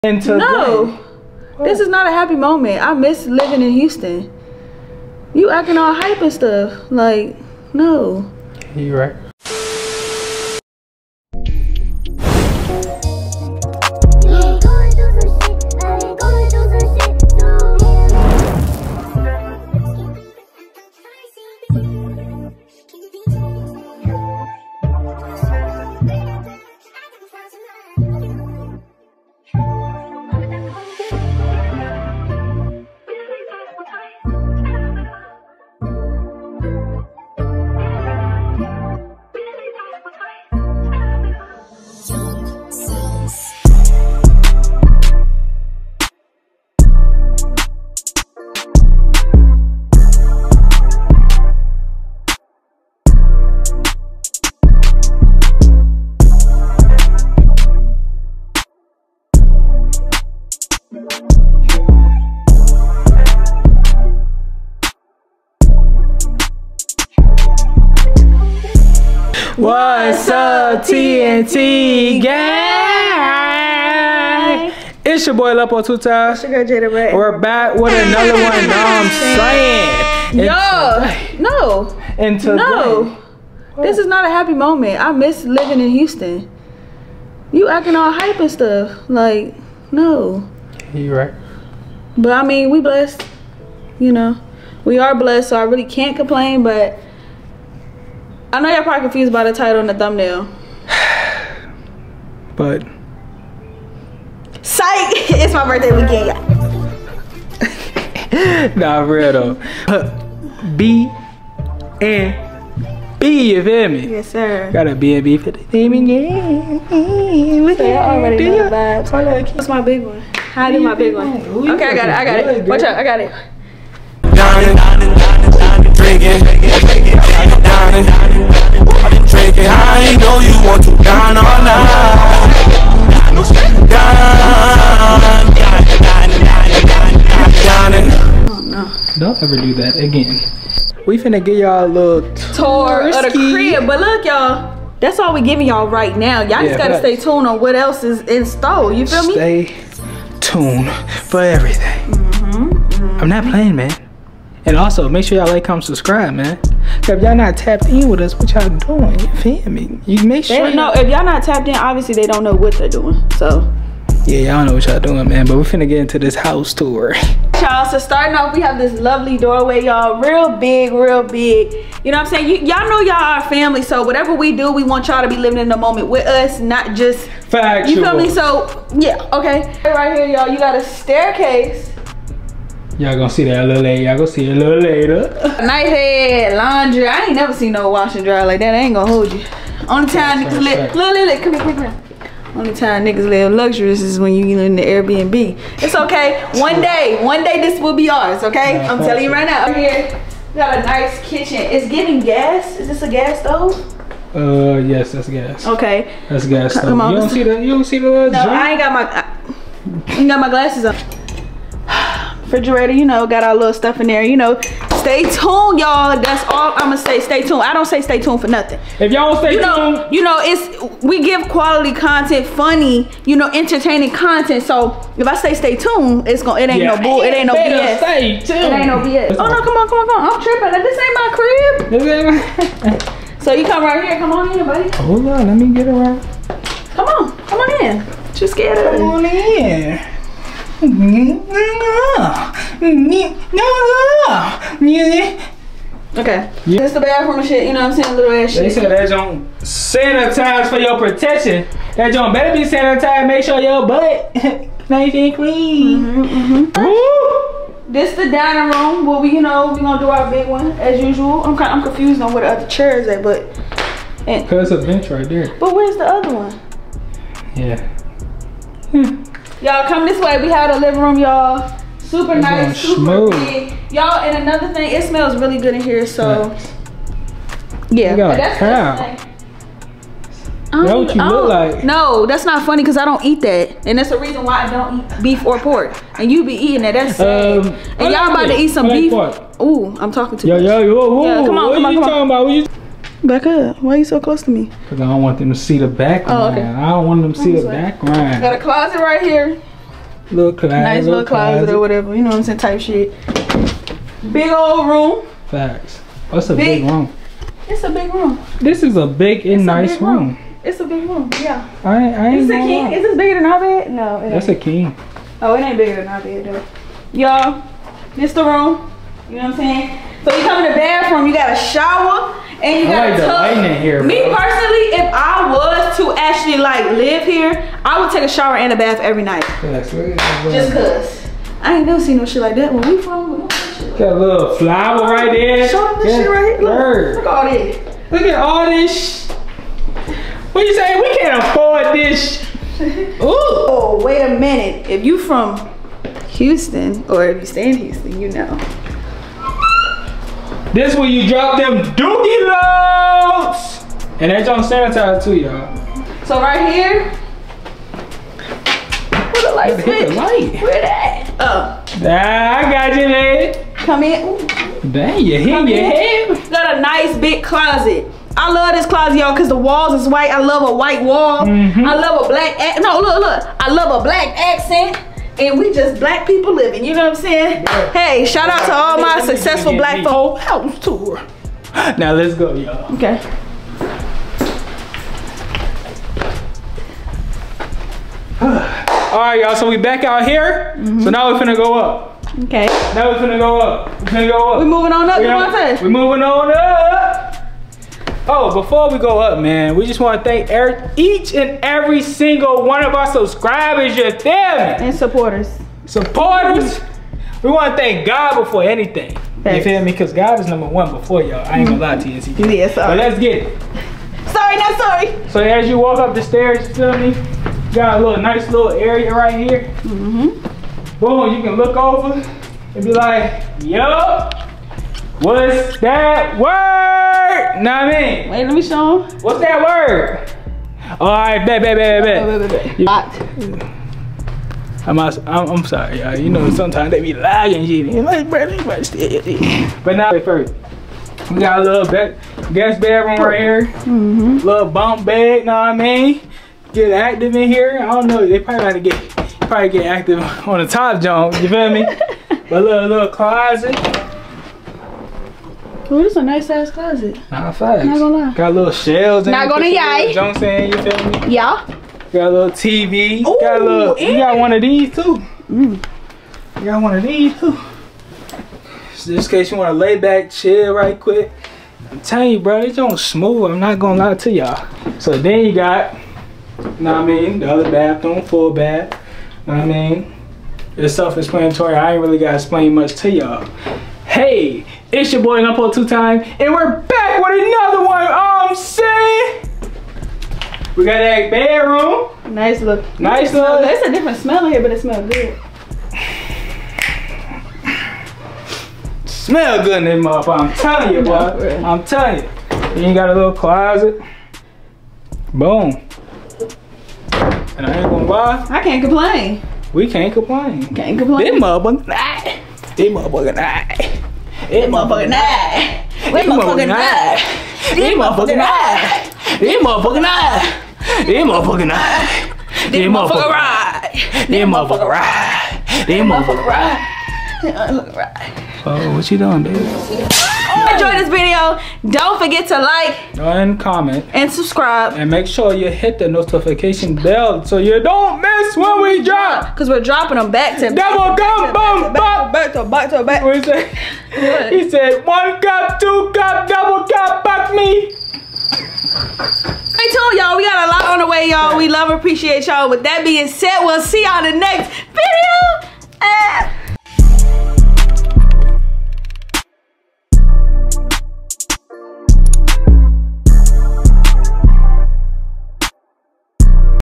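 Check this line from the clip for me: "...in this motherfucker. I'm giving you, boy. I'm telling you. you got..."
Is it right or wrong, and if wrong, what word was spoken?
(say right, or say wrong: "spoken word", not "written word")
wrong: "telling", not "giving".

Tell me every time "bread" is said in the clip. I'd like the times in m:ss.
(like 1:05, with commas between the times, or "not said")
not said.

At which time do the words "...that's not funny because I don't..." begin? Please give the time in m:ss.
4:42.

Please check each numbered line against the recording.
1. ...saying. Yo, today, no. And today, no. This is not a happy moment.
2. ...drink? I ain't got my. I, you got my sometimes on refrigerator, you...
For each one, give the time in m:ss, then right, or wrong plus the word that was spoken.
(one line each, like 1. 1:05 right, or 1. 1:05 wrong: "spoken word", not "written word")
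1. 1:20 right
2. 3:28 wrong: "glasses", not "sometimes".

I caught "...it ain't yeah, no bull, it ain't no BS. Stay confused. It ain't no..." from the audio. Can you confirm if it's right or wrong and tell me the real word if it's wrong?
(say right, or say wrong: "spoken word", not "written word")
wrong: "tuned", not "confused".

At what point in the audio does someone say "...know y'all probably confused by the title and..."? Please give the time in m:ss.
1:38.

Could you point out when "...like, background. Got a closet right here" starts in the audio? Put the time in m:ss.
4:57.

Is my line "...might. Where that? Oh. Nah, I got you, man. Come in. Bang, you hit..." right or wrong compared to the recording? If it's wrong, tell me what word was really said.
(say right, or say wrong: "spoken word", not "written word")
wrong: "light", not "might".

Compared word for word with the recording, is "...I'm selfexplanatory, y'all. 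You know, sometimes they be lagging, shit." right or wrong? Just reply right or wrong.
wrong.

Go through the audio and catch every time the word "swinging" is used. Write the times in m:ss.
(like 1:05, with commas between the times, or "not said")
not said.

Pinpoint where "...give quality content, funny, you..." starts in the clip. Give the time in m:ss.
3:41.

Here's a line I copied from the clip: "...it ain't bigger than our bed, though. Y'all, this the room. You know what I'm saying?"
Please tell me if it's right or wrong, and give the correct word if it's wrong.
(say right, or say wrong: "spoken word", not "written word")
right.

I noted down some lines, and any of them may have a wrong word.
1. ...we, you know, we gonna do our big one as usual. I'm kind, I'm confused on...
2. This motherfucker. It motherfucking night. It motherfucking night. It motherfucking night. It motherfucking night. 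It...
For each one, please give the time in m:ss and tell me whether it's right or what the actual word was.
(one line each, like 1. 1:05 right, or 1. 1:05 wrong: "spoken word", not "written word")
1. 4:19 right
2. 8:32 right.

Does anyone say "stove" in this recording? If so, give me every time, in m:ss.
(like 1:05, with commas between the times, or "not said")
3:23.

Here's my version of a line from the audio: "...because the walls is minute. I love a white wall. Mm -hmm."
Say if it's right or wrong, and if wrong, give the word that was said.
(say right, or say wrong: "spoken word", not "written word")
wrong: "white", not "minute".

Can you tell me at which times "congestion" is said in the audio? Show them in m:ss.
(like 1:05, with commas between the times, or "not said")
not said.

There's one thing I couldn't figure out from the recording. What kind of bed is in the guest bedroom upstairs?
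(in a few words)
Bunk bed.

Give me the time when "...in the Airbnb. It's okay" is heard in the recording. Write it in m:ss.
3:14.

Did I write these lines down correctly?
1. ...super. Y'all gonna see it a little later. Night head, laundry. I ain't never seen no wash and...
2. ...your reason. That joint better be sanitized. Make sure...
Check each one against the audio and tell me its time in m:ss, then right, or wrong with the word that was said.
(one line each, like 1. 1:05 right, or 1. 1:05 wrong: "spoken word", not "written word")
1. 3:03 wrong: "later", not "super"
2. 4:10 wrong: "protection", not "reason".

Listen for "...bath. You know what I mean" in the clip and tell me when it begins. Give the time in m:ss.
7:58.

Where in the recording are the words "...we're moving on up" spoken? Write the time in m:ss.
6:35.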